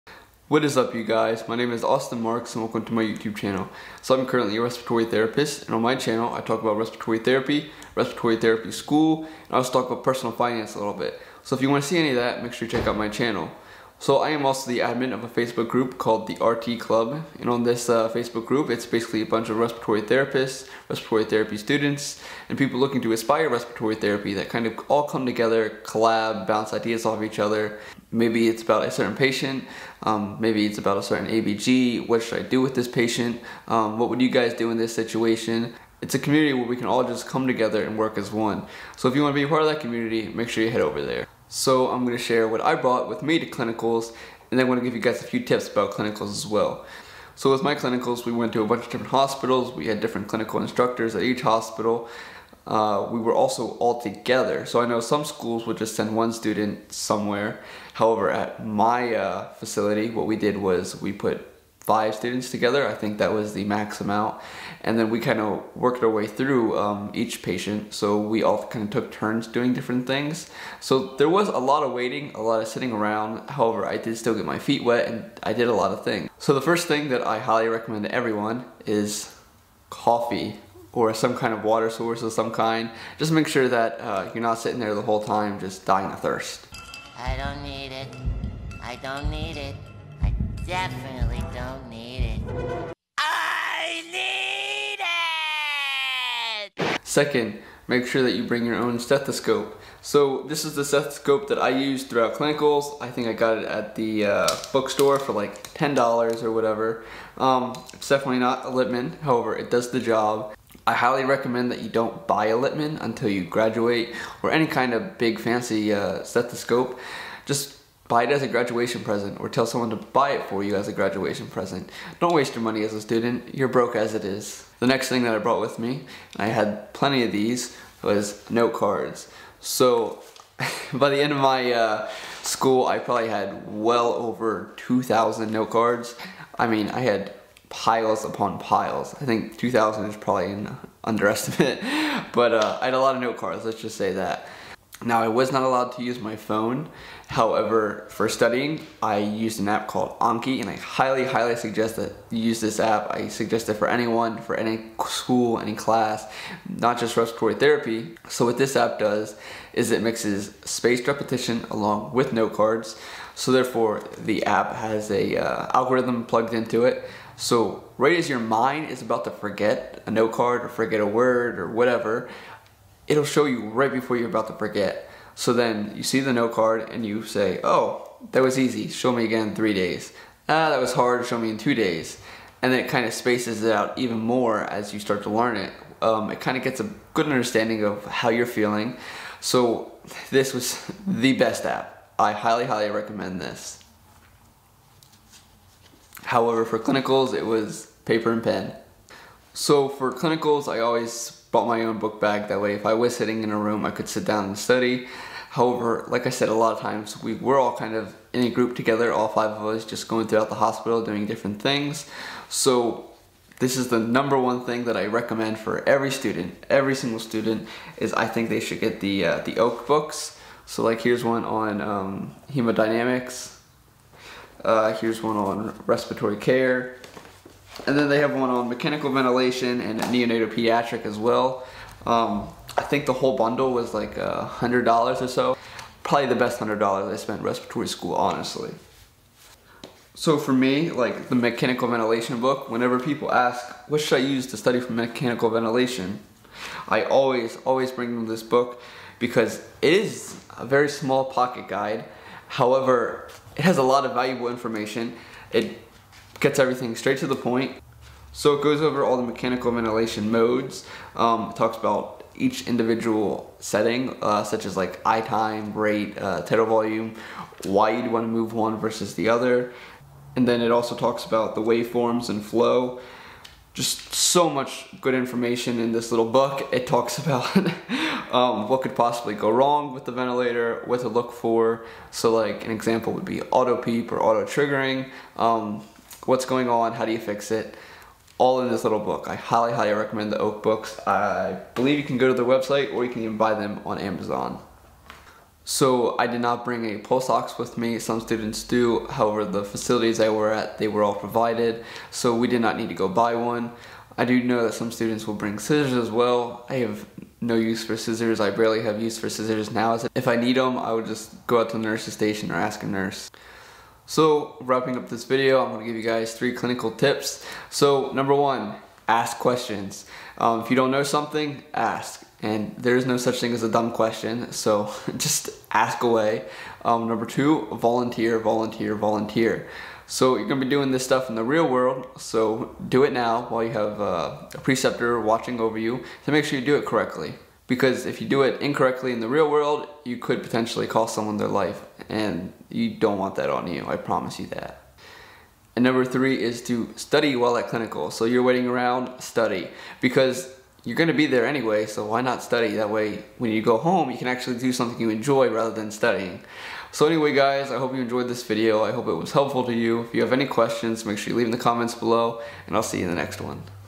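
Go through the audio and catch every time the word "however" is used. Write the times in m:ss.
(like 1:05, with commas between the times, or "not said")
0:57, 1:13, 1:49, 2:27, 3:16, 3:25, 4:12, 4:59.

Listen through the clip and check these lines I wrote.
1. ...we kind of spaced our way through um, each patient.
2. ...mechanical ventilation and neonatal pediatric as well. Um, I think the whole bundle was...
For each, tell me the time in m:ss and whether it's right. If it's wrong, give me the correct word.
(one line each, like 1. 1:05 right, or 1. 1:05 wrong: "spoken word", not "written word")
1. 1:05 wrong: "worked", not "spaced"
2. 3:48 right.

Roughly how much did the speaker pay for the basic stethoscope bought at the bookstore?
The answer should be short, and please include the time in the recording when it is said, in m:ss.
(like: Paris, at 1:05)
$10, at 1:45.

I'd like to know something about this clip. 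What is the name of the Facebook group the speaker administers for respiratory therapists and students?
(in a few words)
The RT Club.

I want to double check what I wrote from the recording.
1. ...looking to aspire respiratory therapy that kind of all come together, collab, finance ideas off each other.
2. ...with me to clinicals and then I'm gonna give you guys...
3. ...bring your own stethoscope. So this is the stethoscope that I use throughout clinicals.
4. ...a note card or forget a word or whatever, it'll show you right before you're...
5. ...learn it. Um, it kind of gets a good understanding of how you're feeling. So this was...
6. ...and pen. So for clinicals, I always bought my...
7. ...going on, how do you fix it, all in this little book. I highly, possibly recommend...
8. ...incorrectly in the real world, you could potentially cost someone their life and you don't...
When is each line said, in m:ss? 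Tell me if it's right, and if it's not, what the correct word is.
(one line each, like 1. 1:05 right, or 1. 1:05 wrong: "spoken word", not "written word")
1. 0:22 wrong: "bounce", not "finance"
2. 0:43 right
3. 1:38 right
4. 2:50 right
5. 3:05 right
6. 3:18 right
7. 4:46 wrong: "highly", not "possibly"
8. 5:38 right.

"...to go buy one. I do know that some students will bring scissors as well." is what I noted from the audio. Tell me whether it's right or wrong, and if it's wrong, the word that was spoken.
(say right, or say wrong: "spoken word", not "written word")
right.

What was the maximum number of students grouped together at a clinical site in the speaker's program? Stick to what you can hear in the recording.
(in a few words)
5.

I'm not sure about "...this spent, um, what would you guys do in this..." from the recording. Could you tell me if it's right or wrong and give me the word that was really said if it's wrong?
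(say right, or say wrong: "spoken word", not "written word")
wrong: "patient", not "spent".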